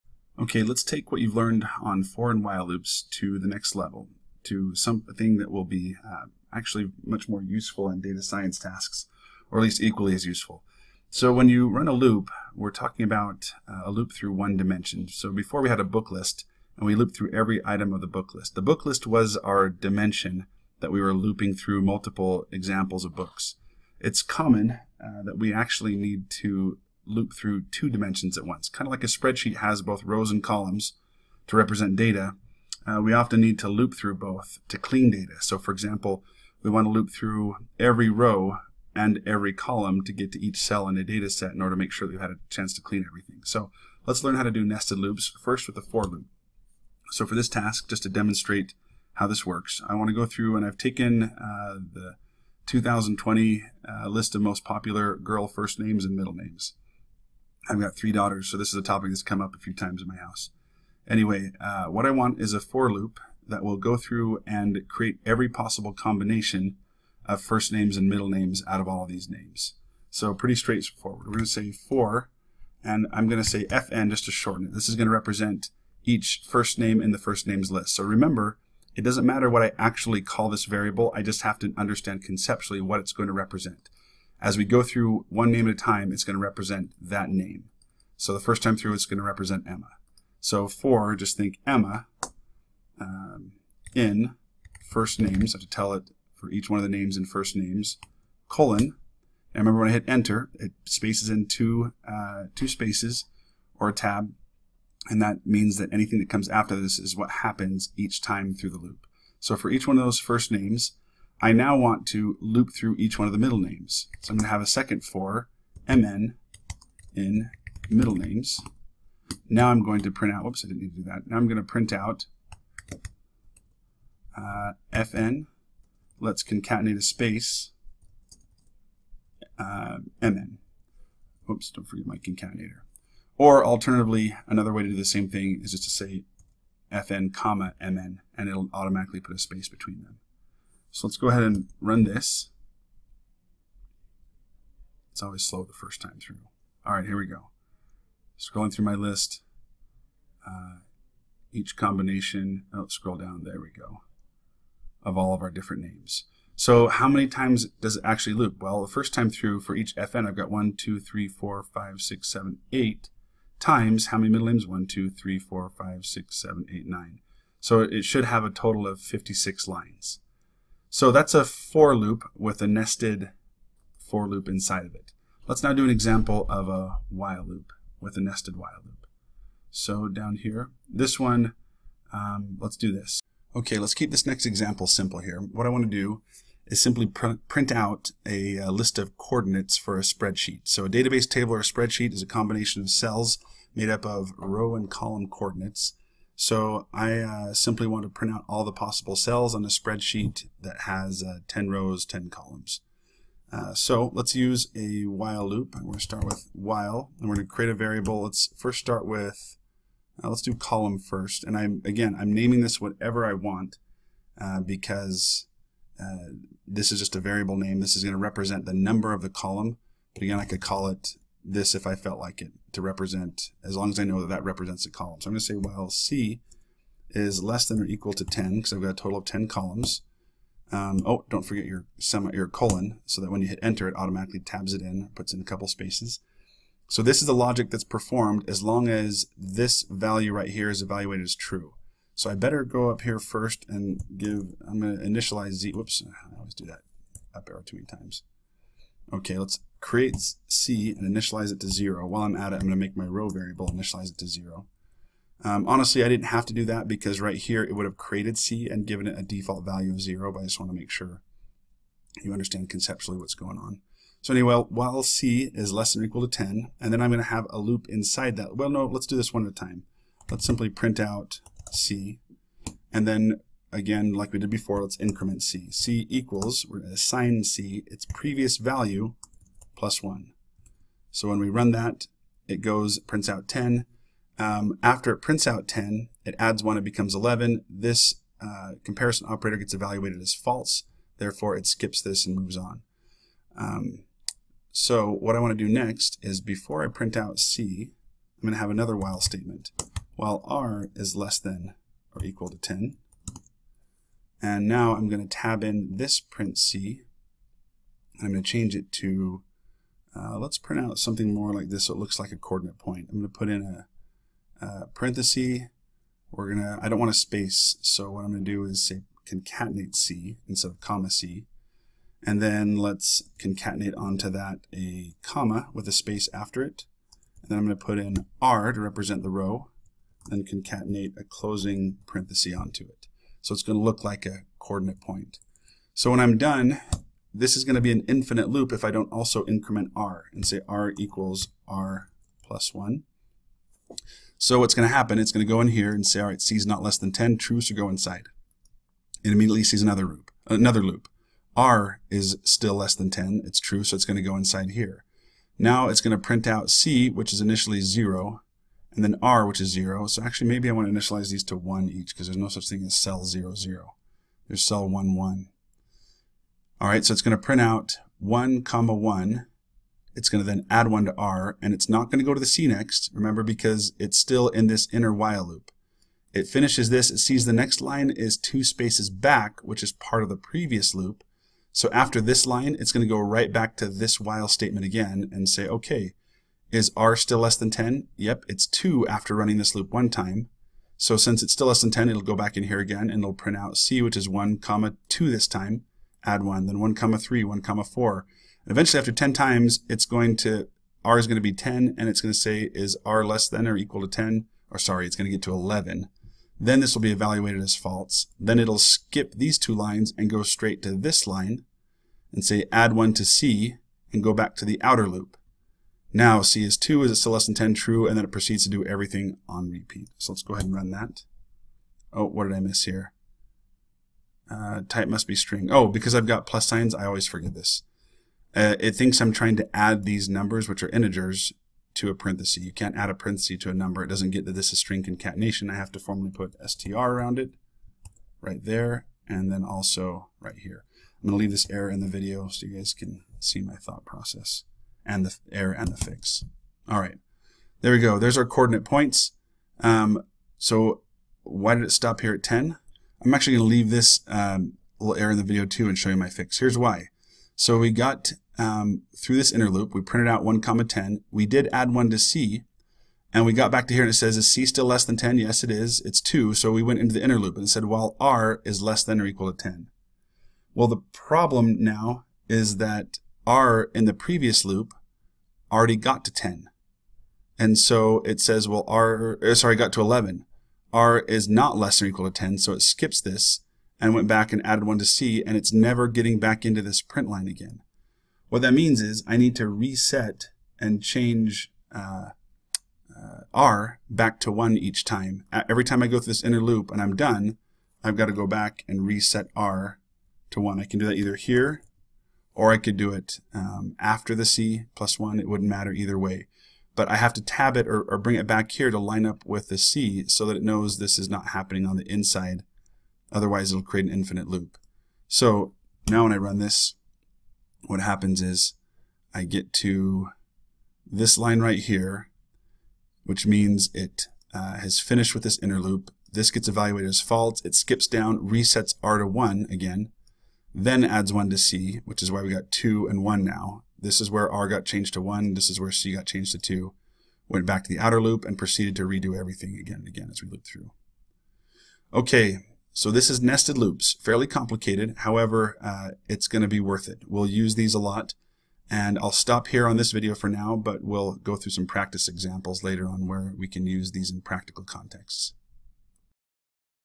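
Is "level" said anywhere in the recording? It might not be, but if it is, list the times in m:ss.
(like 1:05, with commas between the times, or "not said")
0:03.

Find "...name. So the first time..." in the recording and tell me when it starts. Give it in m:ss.
1:27.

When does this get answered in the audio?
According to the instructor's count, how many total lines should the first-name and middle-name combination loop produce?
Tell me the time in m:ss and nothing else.
2:48.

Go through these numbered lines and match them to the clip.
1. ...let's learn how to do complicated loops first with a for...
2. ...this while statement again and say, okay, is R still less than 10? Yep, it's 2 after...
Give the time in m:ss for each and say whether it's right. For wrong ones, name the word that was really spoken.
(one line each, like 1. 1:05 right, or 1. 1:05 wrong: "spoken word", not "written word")
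1. 0:44 wrong: "nested", not "complicated"
2. 6:23 right.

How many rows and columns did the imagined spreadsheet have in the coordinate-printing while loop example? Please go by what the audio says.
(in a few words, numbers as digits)
10.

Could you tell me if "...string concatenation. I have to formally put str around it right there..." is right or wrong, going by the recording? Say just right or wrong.
right.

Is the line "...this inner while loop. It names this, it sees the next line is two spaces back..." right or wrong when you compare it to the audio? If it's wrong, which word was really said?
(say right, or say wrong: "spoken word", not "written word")
wrong: "finishes", not "names".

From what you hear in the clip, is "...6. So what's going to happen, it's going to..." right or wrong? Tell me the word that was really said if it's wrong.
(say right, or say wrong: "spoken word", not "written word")
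wrong: "1", not "6".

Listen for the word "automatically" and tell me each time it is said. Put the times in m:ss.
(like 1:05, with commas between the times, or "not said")
2:18, 3:53.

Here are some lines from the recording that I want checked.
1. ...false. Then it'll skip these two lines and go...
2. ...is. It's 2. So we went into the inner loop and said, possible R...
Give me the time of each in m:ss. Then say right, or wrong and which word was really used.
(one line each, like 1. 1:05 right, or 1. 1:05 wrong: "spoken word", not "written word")
1. 6:47 right
2. 7:45 wrong: "while", not "possible".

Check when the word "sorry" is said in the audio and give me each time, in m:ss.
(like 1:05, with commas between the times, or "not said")
6:44, 7:59.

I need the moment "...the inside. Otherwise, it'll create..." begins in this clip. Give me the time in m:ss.
8:31.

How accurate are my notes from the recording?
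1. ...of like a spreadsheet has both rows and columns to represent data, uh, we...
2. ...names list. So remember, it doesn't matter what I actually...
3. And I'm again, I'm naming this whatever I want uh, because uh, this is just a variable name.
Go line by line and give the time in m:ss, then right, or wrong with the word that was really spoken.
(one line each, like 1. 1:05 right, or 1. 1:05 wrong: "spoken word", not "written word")
1. 0:28 right
2. 1:17 right
3. 3:31 right.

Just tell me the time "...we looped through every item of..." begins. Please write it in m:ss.
0:16.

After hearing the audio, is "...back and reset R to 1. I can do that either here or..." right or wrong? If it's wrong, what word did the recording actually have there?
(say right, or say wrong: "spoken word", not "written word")
right.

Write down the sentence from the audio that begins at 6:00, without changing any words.
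So actually, maybe I want to initialize these to 1 each, because there's no such thing as cell 0, 0.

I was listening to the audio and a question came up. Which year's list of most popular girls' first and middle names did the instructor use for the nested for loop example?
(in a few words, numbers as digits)
2020.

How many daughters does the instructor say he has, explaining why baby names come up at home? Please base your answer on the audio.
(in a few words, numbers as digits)
3.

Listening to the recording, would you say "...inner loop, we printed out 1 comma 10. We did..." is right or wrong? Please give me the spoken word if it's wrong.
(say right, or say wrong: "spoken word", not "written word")
right.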